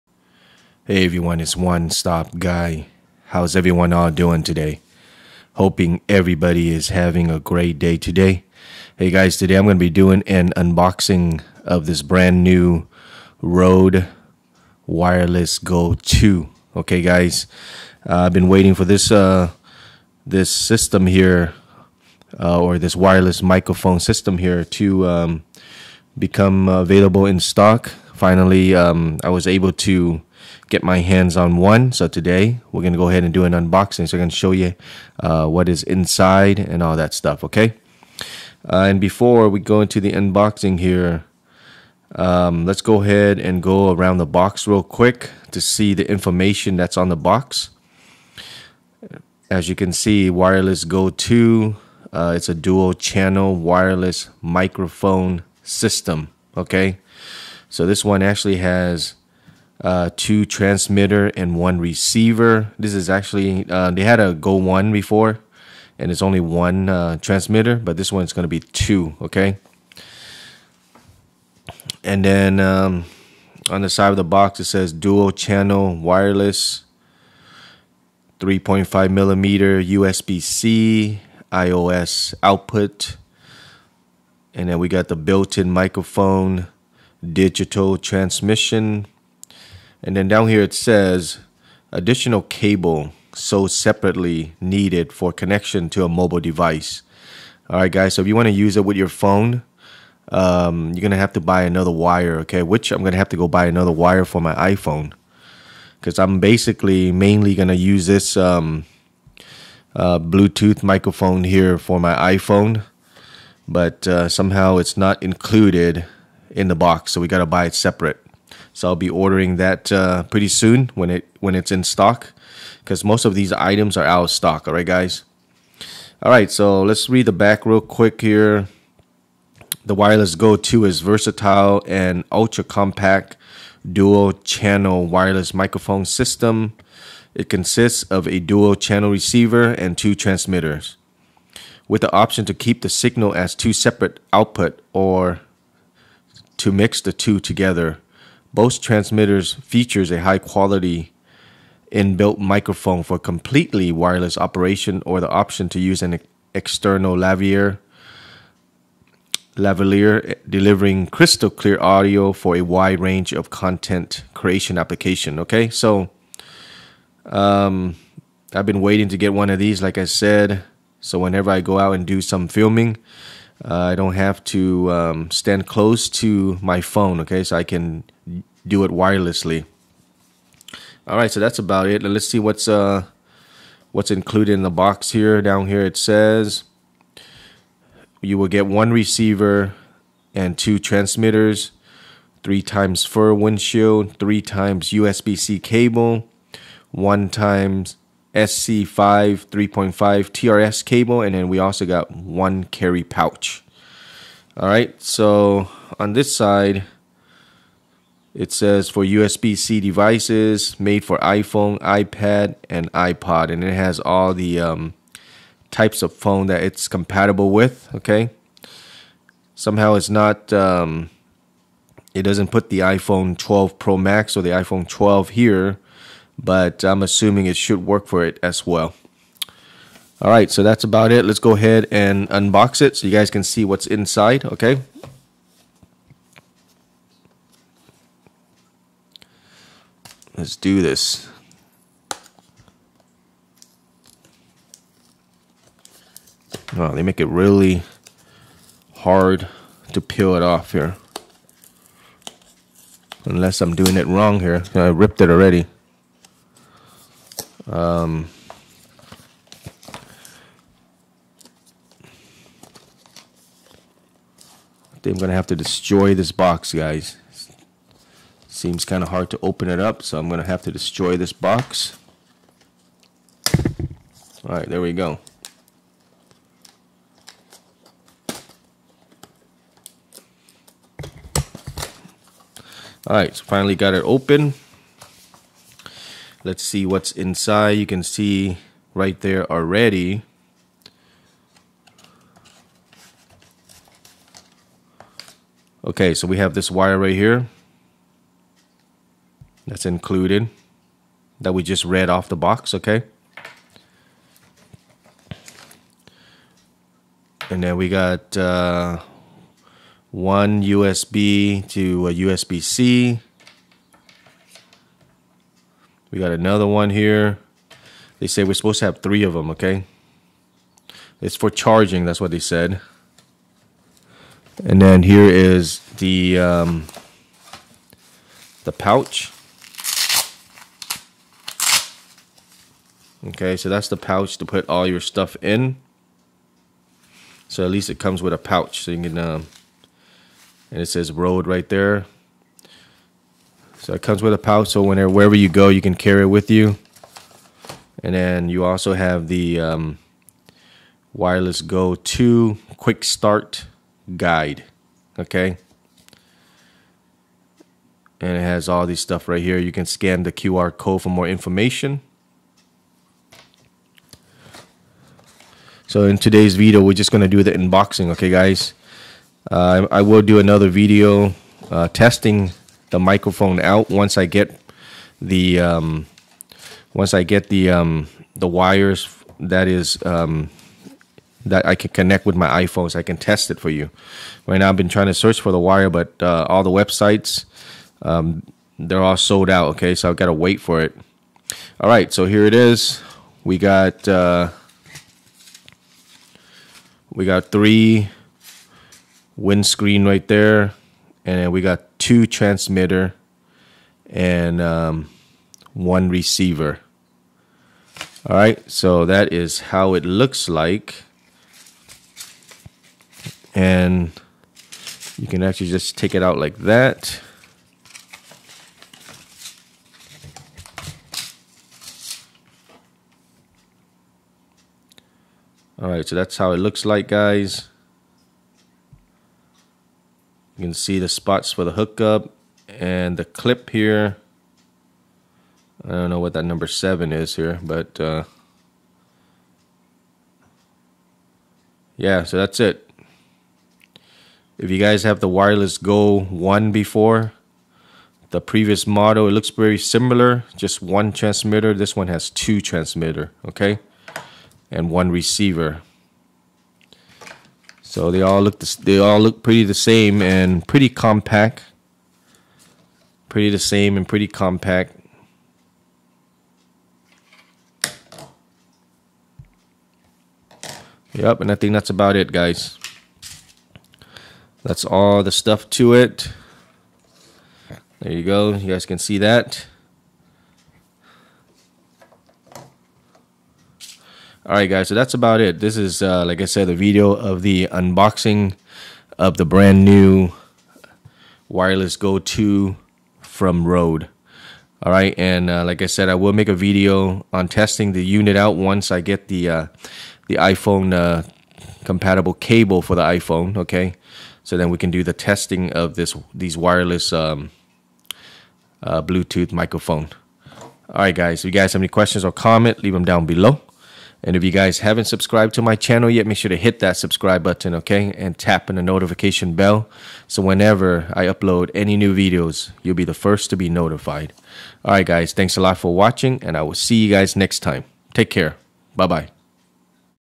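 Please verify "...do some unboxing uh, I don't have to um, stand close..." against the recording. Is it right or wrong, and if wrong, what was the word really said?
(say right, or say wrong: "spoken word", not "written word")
wrong: "filming", not "unboxing".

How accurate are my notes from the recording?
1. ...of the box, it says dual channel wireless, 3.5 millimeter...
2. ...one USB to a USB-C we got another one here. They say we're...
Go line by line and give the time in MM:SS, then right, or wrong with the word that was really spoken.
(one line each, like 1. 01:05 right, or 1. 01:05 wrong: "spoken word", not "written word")
1. 01:14 right
2. 05:10 right.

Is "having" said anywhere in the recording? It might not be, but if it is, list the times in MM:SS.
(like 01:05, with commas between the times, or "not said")
00:06.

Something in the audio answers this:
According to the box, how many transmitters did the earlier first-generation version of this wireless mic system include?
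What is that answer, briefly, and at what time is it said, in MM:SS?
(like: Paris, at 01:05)
1, at 01:06.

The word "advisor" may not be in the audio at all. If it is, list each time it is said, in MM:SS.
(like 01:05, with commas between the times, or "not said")
not said.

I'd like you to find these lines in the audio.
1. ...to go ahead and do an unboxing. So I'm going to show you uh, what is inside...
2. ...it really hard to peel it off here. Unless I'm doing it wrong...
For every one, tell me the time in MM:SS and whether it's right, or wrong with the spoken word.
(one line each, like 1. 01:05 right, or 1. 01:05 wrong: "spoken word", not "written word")
1. 00:32 right
2. 04:07 right.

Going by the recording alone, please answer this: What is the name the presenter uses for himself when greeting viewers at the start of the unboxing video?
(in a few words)
One Stop Guy.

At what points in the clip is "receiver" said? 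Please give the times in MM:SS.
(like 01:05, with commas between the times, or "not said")
01:01, 02:19, 03:08, 06:46, 07:35.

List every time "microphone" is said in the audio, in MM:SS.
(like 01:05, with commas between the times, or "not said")
00:23, 00:54, 01:25, 01:50, 02:15, 02:32, 06:12, 08:29.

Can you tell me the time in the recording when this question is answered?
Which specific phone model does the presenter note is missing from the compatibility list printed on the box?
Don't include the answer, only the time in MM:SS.
03:42.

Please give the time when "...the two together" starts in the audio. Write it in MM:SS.
02:27.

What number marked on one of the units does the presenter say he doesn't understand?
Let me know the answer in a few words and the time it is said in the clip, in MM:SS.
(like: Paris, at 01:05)
7, at 07:16.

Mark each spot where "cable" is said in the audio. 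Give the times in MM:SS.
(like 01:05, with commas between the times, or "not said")
01:32, 03:15, 03:20, 08:22.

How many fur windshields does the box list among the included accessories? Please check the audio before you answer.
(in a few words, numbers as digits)
3.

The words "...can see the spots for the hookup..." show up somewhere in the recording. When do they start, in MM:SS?
07:10.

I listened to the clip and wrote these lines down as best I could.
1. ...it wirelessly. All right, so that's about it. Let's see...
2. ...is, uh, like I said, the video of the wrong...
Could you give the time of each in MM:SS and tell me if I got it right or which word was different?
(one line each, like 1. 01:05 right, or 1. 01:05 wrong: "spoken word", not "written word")
1. 02:58 right
2. 08:05 wrong: "unboxing", not "wrong".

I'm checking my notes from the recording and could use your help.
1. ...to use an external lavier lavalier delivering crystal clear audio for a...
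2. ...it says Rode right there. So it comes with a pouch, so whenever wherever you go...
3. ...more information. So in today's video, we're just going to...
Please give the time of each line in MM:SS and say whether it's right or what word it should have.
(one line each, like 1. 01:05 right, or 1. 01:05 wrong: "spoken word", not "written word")
1. 02:35 right
2. 05:40 right
3. 06:01 right.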